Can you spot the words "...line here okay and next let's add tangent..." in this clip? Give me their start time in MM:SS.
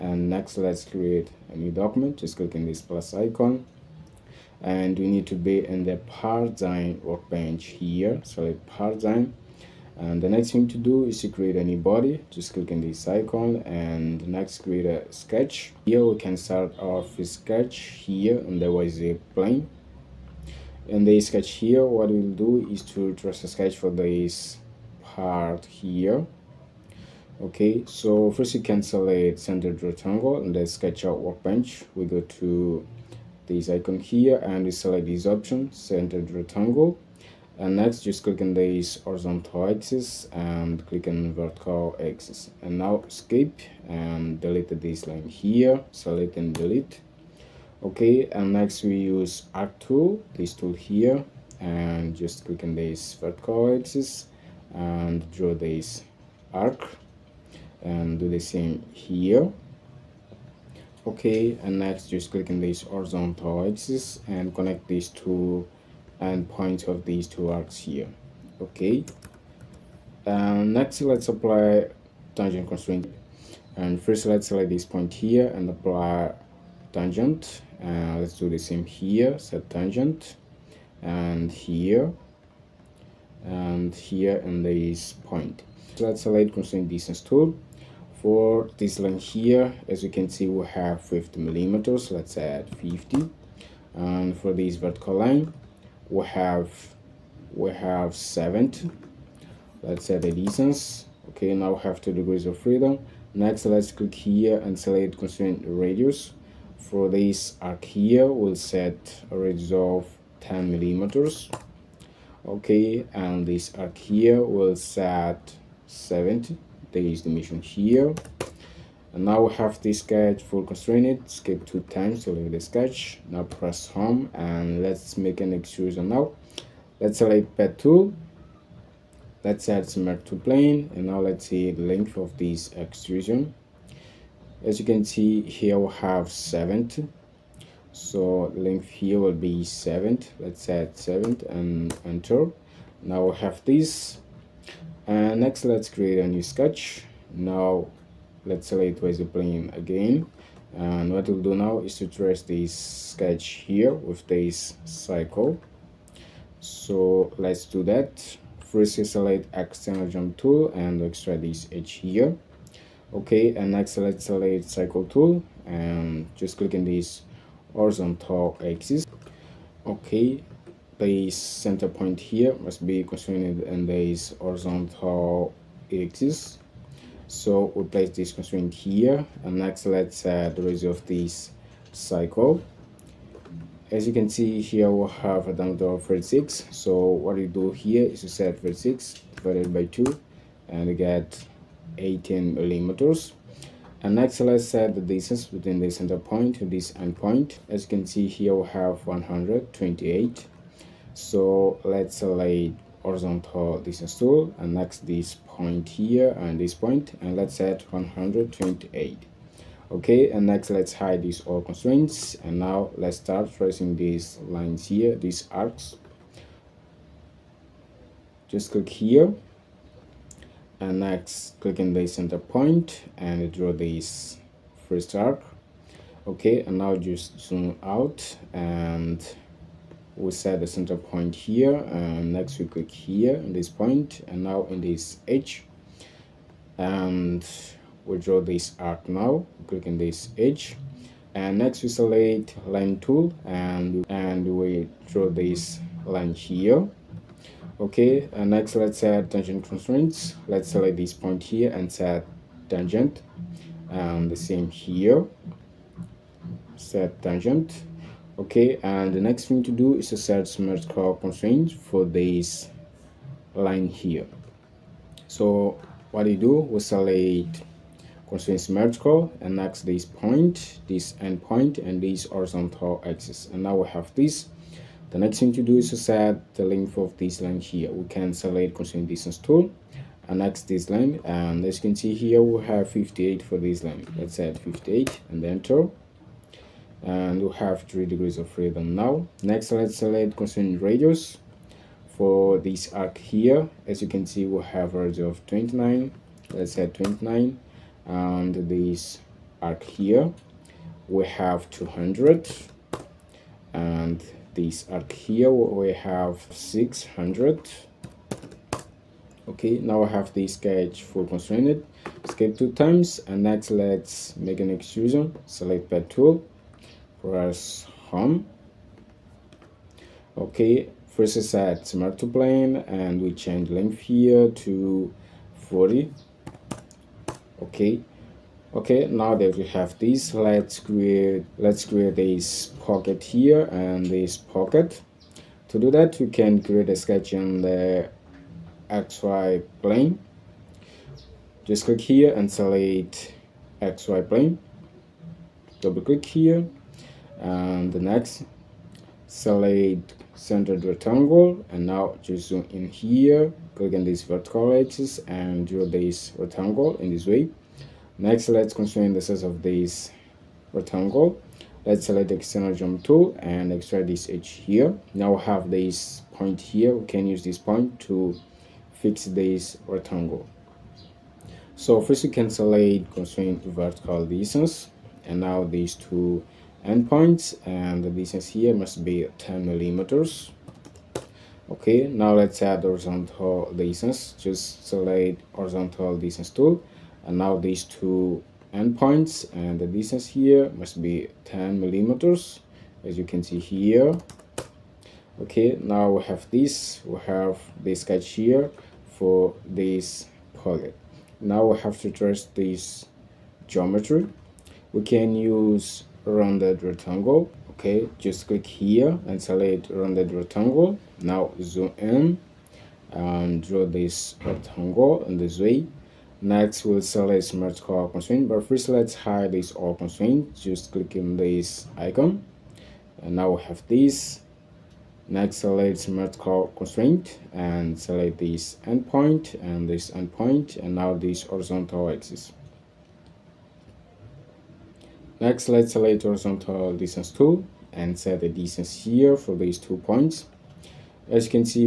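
04:06.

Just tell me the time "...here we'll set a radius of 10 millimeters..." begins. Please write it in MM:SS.
01:47.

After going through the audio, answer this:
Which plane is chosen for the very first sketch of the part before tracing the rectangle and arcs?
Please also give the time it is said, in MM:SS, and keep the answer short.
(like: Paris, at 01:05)
YZ plane, at 00:18.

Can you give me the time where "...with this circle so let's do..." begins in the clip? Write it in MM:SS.
02:33.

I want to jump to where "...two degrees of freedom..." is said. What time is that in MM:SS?
01:42.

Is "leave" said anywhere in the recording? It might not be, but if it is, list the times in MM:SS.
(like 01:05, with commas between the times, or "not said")
02:02.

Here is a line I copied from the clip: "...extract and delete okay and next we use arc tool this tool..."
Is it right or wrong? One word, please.
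wrong.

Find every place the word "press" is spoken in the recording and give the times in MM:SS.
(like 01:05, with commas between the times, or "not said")
02:03, 05:17.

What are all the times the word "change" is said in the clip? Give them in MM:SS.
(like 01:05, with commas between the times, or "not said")
05:23.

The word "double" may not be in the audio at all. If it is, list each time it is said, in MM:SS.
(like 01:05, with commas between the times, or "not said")
05:45.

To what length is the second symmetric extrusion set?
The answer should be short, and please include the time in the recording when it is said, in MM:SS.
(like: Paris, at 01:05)
40, at 05:25.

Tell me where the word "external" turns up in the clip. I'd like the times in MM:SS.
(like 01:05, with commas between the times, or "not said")
02:39, 06:02.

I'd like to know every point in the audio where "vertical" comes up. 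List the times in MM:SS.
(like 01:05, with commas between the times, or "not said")
00:41, 00:53, 01:34, 05:54, 06:13.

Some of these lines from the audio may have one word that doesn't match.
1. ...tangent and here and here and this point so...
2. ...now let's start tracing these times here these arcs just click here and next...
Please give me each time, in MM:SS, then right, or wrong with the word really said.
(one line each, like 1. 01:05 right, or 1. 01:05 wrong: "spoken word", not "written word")
1. 01:19 right
2. 03:32 wrong: "lines", not "times".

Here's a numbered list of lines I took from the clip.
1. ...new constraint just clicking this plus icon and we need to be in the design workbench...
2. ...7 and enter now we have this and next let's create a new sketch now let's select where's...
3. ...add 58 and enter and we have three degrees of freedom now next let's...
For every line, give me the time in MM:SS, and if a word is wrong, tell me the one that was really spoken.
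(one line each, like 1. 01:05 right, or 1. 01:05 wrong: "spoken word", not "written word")
1. 00:01 wrong: "document", not "constraint"
2. 02:20 right
3. 04:44 right.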